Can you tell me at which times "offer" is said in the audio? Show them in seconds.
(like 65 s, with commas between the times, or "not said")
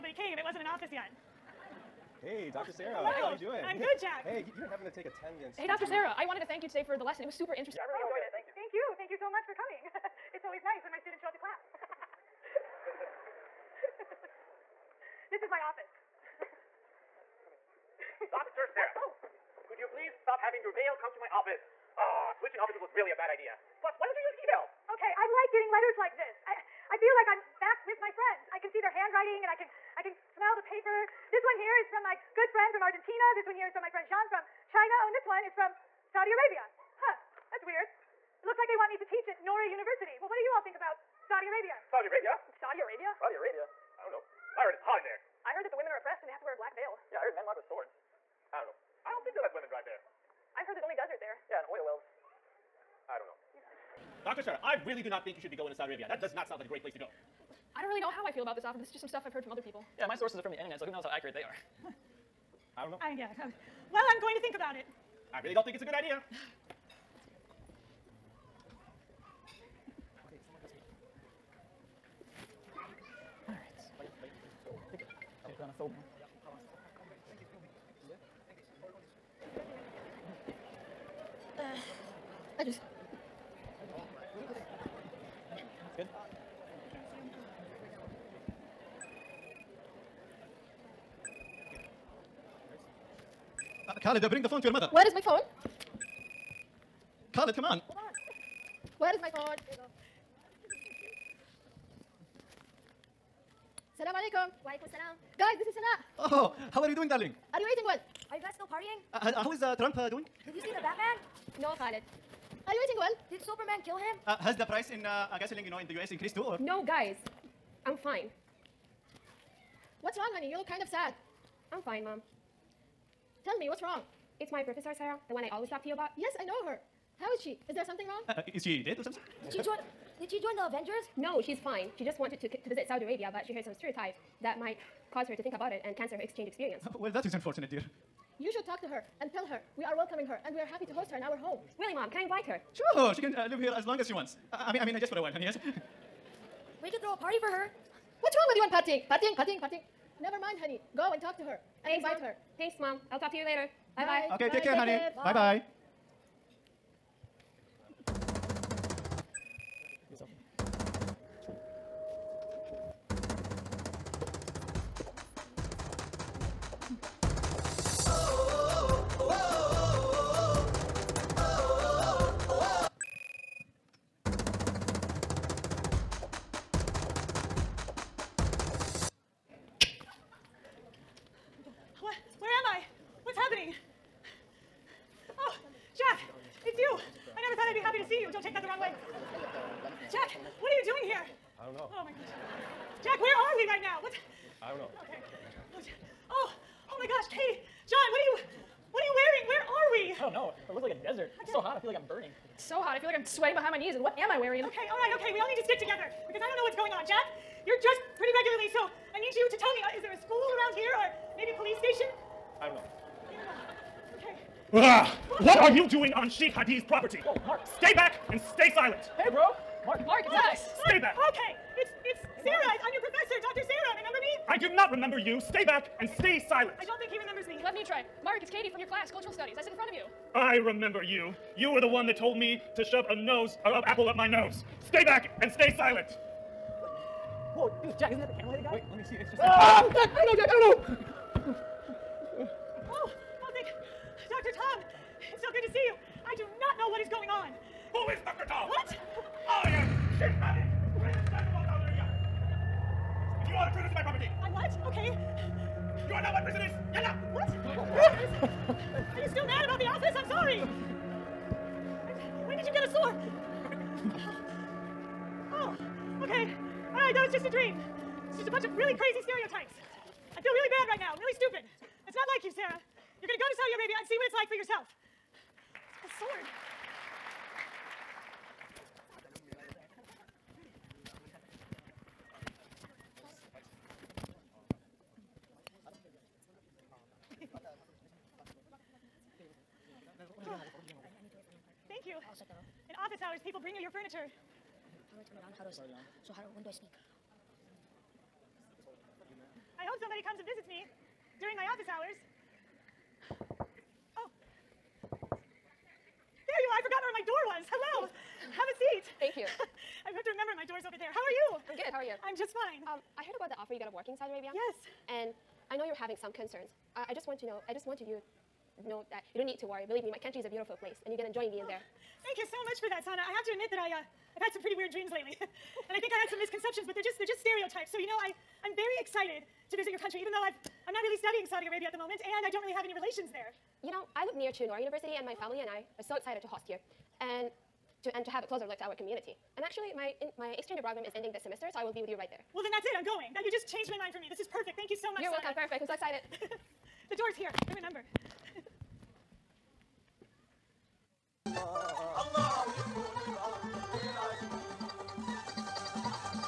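58 s, 313 s.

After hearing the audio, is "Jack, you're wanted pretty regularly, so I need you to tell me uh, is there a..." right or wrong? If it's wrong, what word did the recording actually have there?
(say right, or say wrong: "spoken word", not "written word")
wrong: "dressed", not "wanted".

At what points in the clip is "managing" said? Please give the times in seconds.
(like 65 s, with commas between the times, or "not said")
not said.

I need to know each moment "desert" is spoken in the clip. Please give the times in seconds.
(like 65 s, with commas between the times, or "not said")
50 s, 201 s.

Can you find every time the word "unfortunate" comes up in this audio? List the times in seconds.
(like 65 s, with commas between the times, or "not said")
137 s.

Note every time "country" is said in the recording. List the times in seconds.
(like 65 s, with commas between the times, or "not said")
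320 s, 329 s.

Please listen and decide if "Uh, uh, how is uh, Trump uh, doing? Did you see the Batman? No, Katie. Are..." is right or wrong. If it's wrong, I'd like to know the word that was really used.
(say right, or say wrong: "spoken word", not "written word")
wrong: "Khaled", not "Katie".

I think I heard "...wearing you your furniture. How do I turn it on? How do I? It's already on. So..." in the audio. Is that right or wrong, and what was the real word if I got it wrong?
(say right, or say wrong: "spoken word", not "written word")
wrong: "bring", not "wearing".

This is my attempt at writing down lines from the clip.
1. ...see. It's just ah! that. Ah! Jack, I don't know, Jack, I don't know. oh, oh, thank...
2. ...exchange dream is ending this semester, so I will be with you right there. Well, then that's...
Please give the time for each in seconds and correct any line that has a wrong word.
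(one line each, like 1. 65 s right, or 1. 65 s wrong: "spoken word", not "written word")
1. 239 s right
2. 340 s wrong: "program", not "dream".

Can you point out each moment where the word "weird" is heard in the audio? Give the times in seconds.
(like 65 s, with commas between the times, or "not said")
37 s, 324 s.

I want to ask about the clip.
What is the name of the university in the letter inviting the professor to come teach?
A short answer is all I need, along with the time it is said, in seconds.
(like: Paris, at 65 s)
Nora University, at 39 s.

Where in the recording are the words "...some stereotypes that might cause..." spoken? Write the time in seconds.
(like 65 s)
133 s.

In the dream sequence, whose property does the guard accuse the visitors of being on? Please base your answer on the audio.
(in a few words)
Sheikh Hadi.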